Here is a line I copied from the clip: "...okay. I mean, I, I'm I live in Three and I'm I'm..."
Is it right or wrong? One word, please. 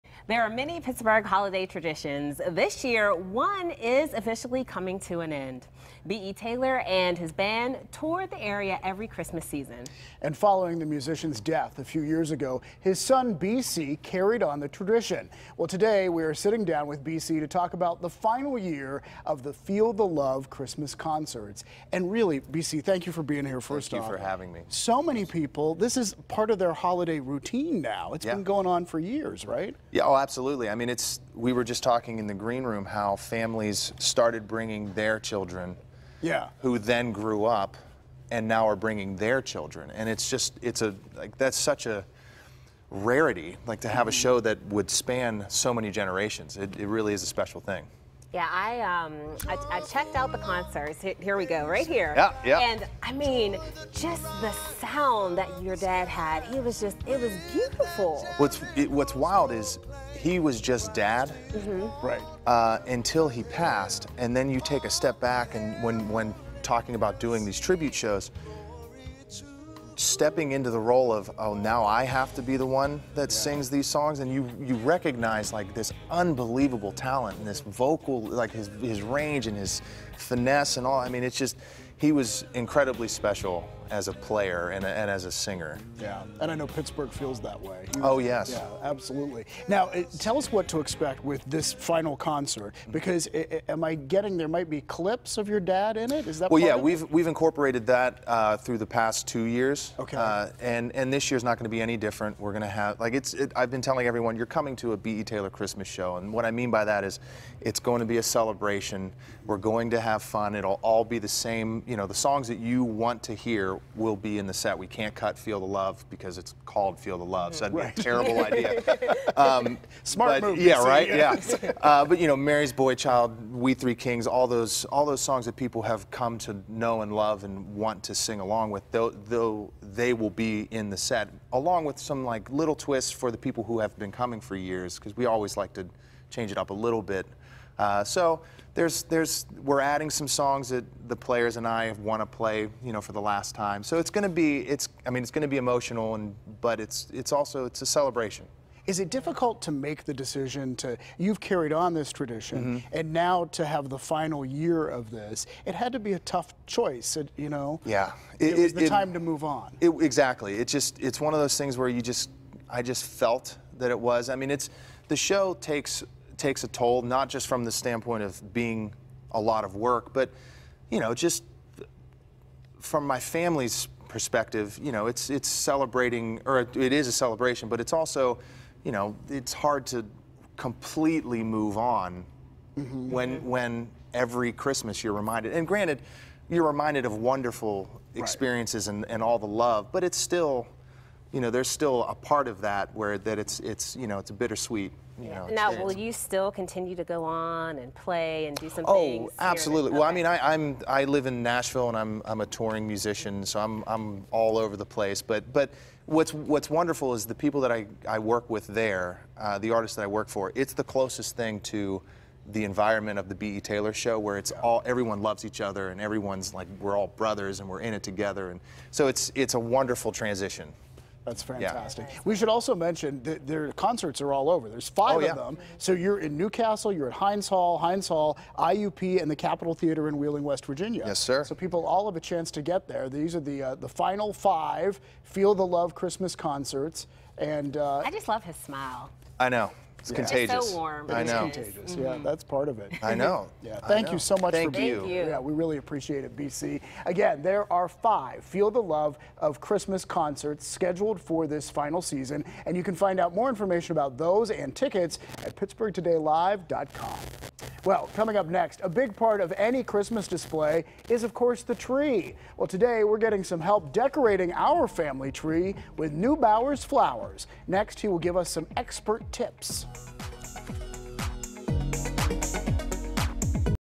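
wrong.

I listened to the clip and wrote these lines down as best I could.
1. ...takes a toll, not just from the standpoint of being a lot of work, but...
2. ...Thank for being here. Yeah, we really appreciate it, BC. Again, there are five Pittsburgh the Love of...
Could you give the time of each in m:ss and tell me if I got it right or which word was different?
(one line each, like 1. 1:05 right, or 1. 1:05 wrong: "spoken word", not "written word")
1. 2:46 right
2. 4:04 wrong: "Feel", not "Pittsburgh".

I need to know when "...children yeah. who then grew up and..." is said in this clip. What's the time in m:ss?
0:35.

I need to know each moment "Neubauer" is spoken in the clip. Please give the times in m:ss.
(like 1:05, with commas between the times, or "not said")
4:26.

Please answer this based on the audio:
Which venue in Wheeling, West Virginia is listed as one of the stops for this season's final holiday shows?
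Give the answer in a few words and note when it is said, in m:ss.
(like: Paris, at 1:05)
Capitol Theater, at 3:49.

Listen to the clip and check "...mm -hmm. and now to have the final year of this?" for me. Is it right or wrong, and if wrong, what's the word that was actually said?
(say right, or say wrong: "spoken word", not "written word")
right.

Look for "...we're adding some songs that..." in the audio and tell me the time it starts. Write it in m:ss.
2:19.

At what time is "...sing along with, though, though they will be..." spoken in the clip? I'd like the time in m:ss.
2:08.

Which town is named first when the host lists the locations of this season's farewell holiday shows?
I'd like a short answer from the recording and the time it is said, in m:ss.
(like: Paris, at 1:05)
New Castle, at 3:46.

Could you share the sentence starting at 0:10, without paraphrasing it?
And following the musician's death a few years ago, his son B.C.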